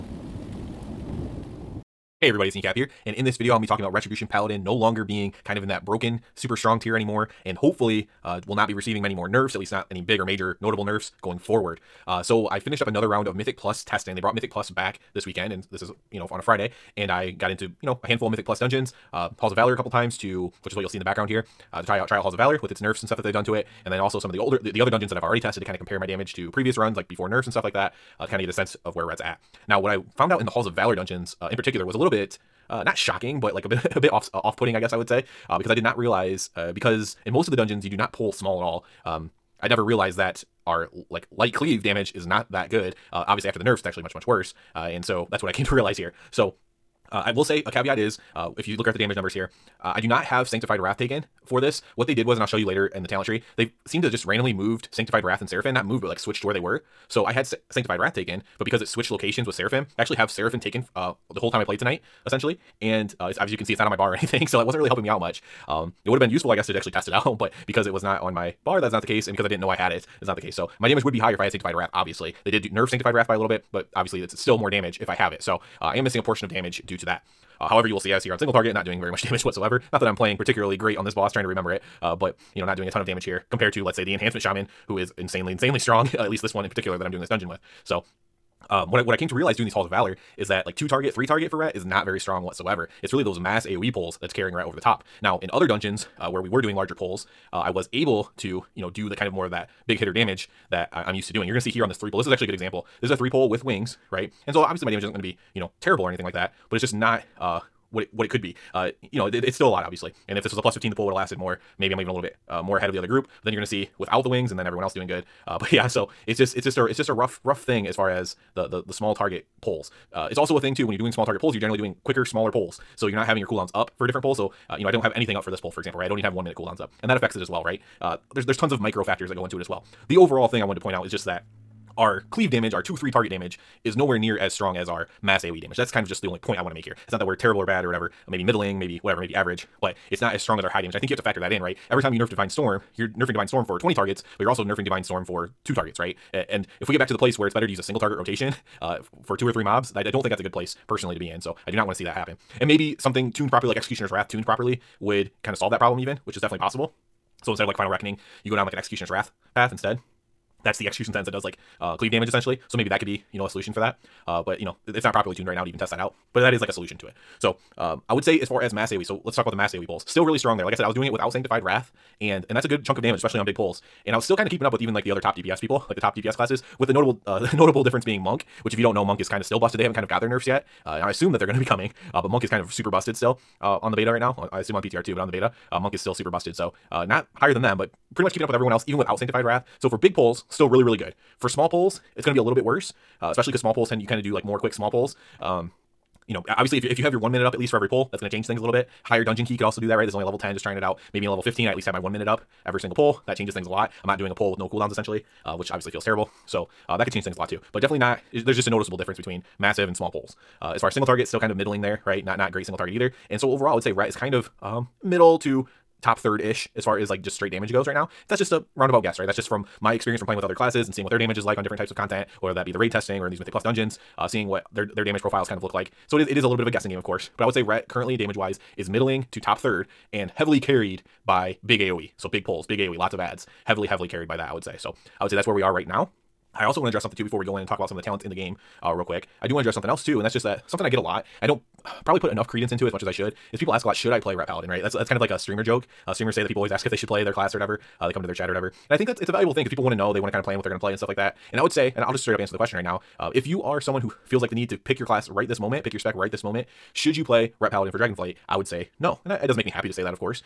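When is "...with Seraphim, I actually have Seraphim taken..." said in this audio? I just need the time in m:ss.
0:59.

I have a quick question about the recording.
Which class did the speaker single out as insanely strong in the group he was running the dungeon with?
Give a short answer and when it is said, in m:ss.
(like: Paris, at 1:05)
enhancement shaman, at 1:24.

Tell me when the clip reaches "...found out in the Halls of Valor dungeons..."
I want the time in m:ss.
0:30.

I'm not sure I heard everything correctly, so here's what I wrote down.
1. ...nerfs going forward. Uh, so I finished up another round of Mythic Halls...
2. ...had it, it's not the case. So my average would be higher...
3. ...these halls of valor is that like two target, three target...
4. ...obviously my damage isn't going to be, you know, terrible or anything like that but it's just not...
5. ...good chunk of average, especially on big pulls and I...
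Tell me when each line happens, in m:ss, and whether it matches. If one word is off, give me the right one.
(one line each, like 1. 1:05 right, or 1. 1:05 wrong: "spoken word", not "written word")
1. 0:10 wrong: "Plus", not "Halls"
2. 1:09 wrong: "damage", not "average"
3. 1:29 right
4. 1:44 right
5. 2:52 wrong: "damage", not "average".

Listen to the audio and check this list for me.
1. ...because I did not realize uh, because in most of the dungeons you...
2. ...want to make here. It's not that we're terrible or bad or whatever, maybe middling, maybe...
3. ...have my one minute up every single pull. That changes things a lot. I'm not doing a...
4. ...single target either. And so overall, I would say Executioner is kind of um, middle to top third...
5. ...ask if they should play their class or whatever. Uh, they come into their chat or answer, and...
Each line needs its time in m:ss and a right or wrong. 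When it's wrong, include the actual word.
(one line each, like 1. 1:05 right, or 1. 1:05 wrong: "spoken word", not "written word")
1. 0:35 right
2. 2:16 right
3. 3:21 right
4. 3:32 wrong: "Ret", not "Executioner"
5. 4:06 wrong: "whatever", not "answer".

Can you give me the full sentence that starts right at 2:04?
So, uh, you know, I don't have anything up for this pull, for example, right?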